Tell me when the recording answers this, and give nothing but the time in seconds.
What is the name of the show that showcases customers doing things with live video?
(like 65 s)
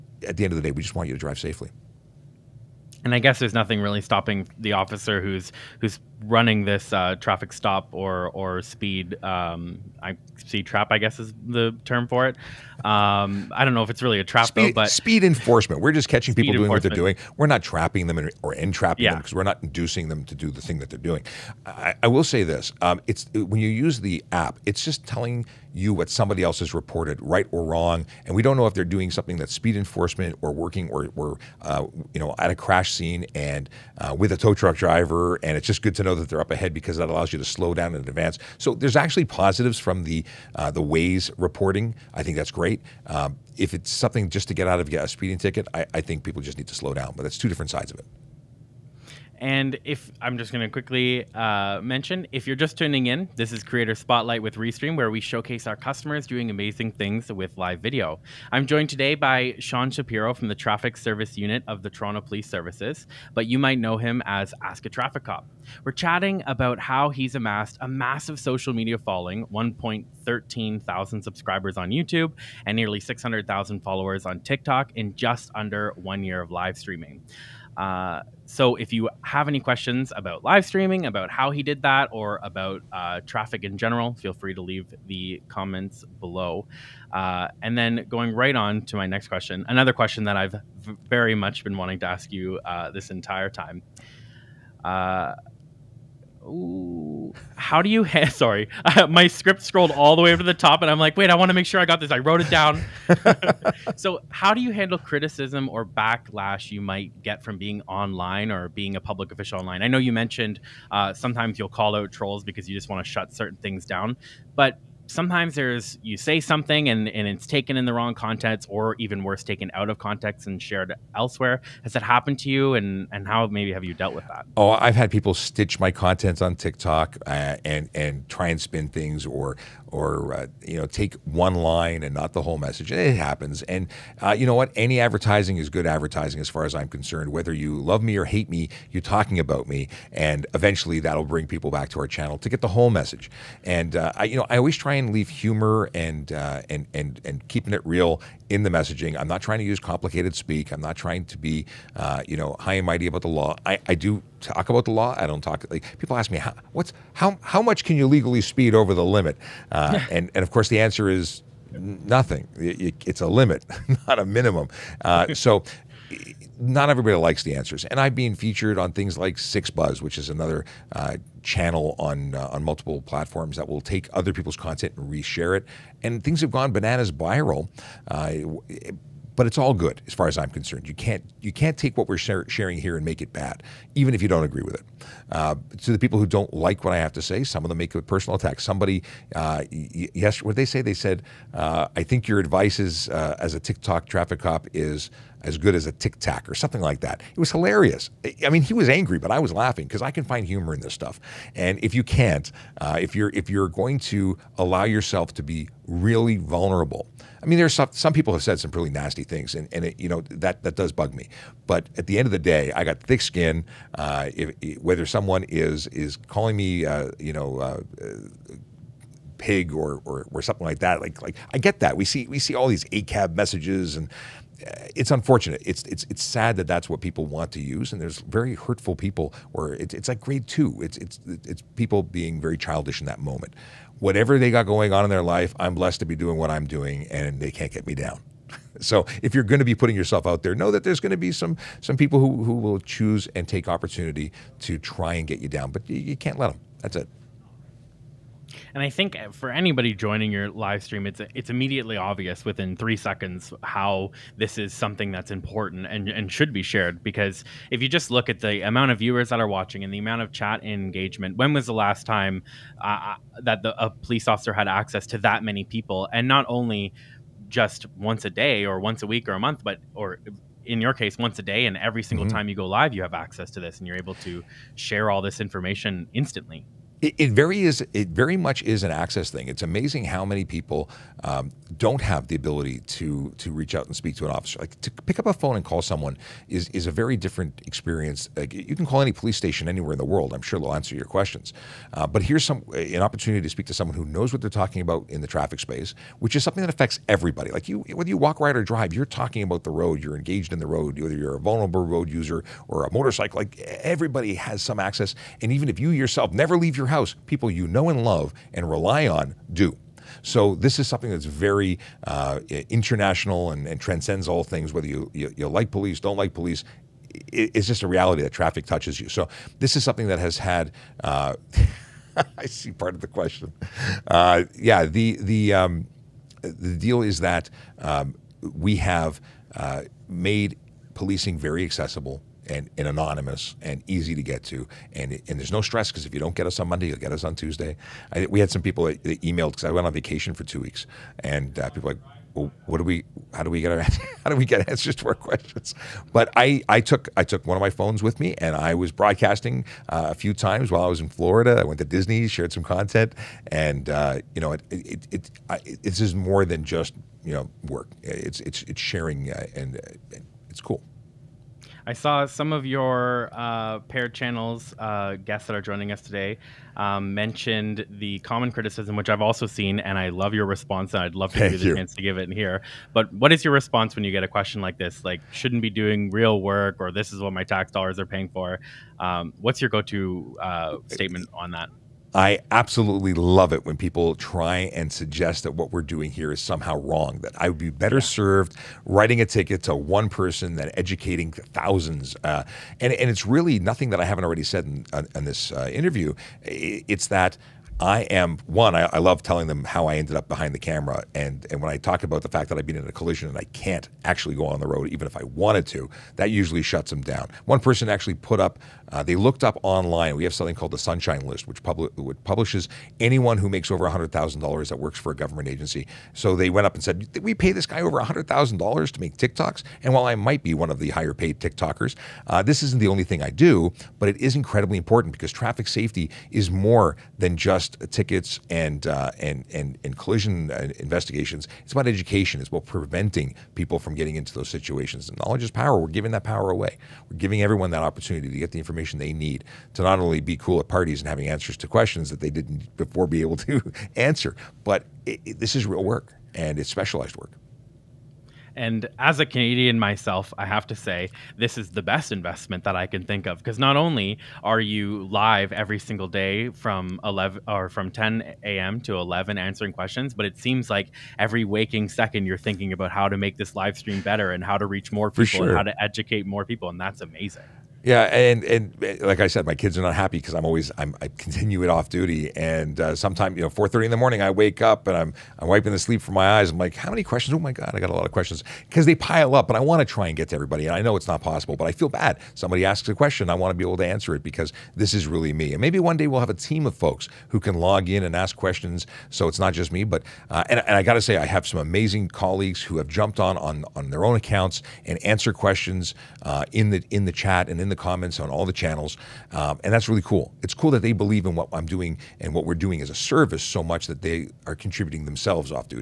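53 s.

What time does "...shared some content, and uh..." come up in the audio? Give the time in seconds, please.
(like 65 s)
352 s.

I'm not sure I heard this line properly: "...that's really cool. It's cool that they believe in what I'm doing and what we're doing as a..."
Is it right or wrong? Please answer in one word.
right.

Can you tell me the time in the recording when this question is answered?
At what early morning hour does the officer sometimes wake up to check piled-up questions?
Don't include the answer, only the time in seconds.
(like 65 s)
473 s.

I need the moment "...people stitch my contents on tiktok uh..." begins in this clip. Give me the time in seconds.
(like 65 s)
125 s.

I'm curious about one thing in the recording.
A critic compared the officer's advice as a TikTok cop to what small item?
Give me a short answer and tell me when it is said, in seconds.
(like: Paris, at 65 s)
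a tic tac, at 195 s.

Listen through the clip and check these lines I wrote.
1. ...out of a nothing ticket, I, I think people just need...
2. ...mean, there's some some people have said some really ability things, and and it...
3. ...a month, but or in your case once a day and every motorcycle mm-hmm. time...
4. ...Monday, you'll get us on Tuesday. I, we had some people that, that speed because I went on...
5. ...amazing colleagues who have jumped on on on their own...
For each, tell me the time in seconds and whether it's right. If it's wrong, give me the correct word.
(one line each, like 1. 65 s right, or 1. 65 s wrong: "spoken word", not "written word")
1. 44 s wrong: "speeding", not "nothing"
2. 207 s wrong: "nasty", not "ability"
3. 269 s wrong: "single", not "motorcycle"
4. 336 s wrong: "emailed", not "speed"
5. 491 s right.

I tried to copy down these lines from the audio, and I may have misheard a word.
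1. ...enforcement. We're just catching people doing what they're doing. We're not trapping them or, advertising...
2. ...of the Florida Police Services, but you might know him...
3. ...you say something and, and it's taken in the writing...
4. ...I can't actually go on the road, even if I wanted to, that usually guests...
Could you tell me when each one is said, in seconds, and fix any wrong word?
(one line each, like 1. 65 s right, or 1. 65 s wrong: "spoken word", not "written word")
1. 15 s wrong: "entrapping", not "advertising"
2. 61 s wrong: "Toronto", not "Florida"
3. 116 s wrong: "wrong", not "writing"
4. 403 s wrong: "shuts", not "guests".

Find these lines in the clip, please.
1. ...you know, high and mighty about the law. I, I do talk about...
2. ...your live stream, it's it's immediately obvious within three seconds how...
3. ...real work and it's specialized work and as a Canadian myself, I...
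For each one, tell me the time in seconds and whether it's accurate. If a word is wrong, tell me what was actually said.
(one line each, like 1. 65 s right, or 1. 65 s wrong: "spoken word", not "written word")
1. 152 s right
2. 250 s right
3. 445 s right.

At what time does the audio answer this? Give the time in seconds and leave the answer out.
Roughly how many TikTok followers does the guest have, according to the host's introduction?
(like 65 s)
72 s.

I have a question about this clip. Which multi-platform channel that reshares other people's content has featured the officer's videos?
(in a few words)
6ixBuzz.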